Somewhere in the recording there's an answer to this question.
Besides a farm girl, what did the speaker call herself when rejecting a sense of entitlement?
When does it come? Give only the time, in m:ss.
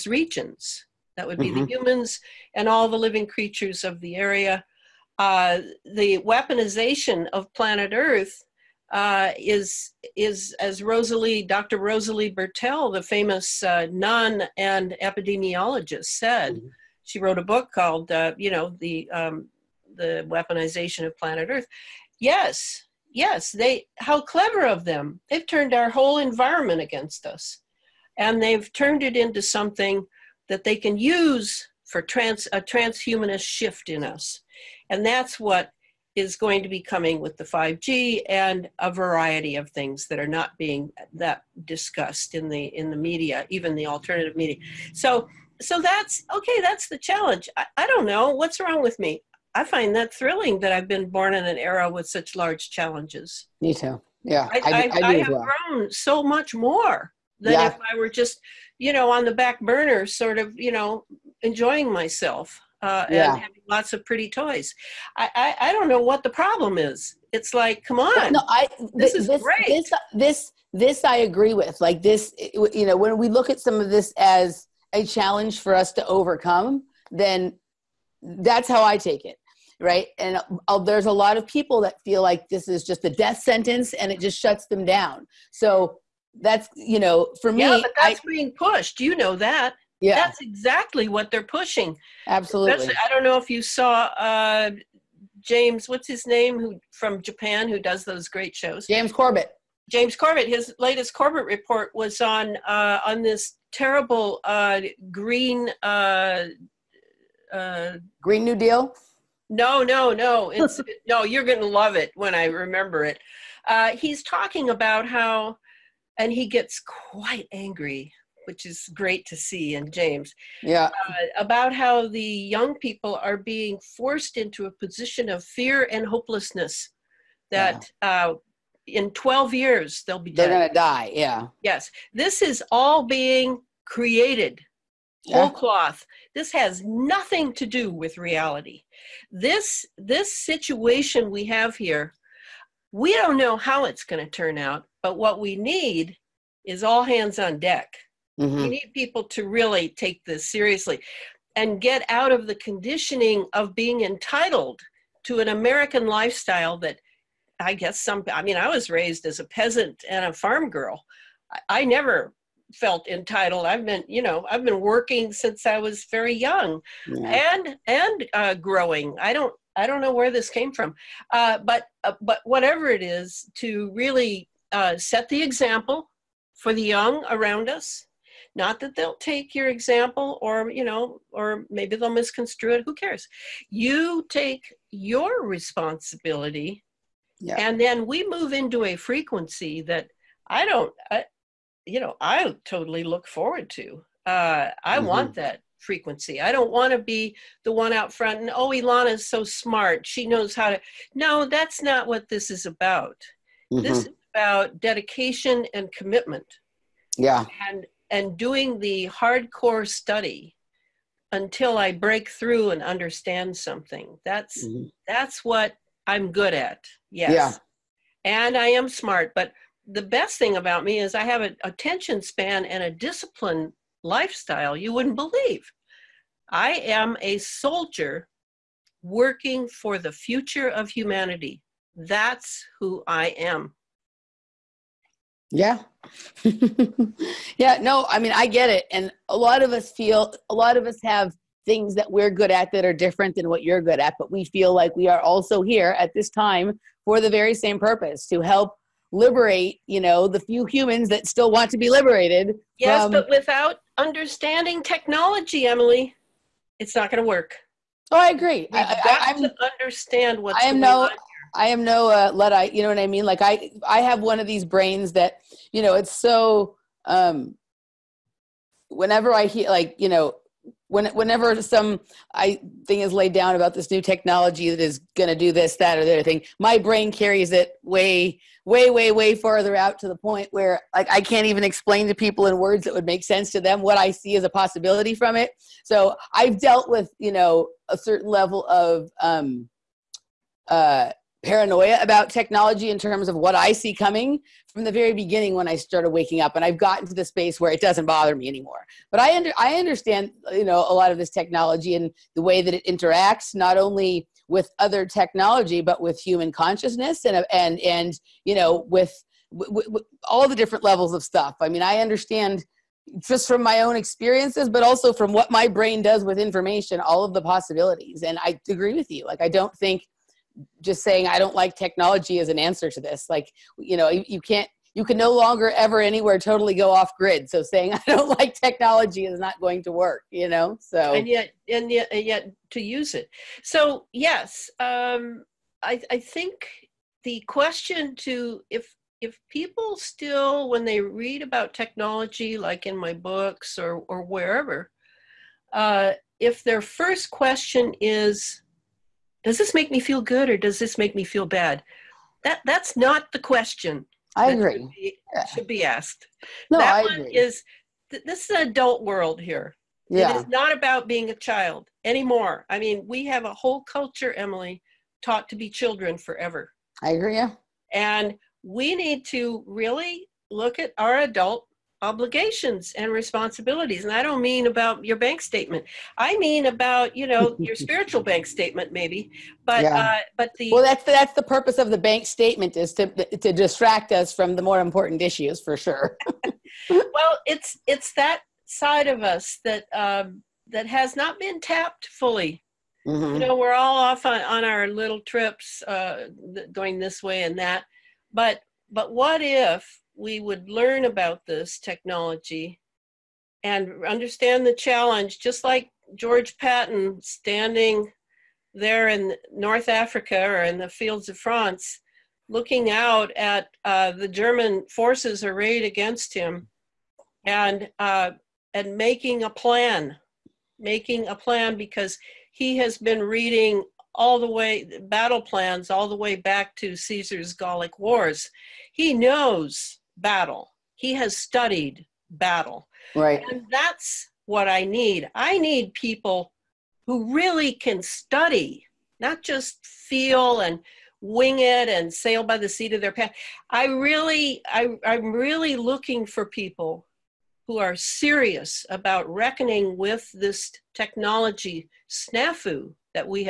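2:39.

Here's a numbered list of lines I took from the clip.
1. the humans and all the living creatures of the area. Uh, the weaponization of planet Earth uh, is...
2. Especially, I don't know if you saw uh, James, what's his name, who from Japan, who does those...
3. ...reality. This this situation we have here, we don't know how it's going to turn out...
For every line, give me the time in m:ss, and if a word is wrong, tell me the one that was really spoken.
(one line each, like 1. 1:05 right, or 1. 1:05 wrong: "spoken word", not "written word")
1. 0:01 right
2. 1:32 right
3. 2:18 right.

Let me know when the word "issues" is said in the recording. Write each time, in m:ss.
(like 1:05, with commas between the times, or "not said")
6:25.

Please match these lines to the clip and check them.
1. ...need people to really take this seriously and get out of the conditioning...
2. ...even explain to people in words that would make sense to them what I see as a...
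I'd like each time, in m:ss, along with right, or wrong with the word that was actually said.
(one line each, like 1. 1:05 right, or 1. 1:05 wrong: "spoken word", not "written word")
1. 2:28 right
2. 4:41 right.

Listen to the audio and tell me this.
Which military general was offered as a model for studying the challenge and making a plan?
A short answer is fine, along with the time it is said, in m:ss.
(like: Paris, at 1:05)
George Patton, at 6:46.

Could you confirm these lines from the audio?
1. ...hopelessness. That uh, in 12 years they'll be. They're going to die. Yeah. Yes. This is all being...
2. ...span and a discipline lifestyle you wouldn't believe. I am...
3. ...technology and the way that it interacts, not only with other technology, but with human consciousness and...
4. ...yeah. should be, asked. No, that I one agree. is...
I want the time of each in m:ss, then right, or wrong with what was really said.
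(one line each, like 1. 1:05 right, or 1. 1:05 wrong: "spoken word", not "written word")
1. 2:06 right
2. 3:42 right
3. 5:01 right
4. 5:55 right.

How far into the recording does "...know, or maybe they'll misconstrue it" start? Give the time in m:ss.
3:00.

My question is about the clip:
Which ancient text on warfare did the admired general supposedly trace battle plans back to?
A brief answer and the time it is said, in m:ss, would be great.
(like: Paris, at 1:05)
Caesar's Gallic Wars, at 7:06.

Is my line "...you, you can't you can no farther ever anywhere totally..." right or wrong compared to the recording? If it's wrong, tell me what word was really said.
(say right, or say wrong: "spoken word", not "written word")
wrong: "longer", not "farther".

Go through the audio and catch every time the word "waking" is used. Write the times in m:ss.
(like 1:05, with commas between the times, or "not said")
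4:56.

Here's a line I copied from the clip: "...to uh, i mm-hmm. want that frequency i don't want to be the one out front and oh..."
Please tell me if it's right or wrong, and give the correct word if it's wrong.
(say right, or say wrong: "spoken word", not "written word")
right.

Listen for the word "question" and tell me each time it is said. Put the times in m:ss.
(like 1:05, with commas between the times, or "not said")
5:37, 5:47, 5:53.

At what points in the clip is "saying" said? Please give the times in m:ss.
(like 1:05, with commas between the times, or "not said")
5:21, 5:27.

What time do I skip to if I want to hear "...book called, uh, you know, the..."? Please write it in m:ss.
0:17.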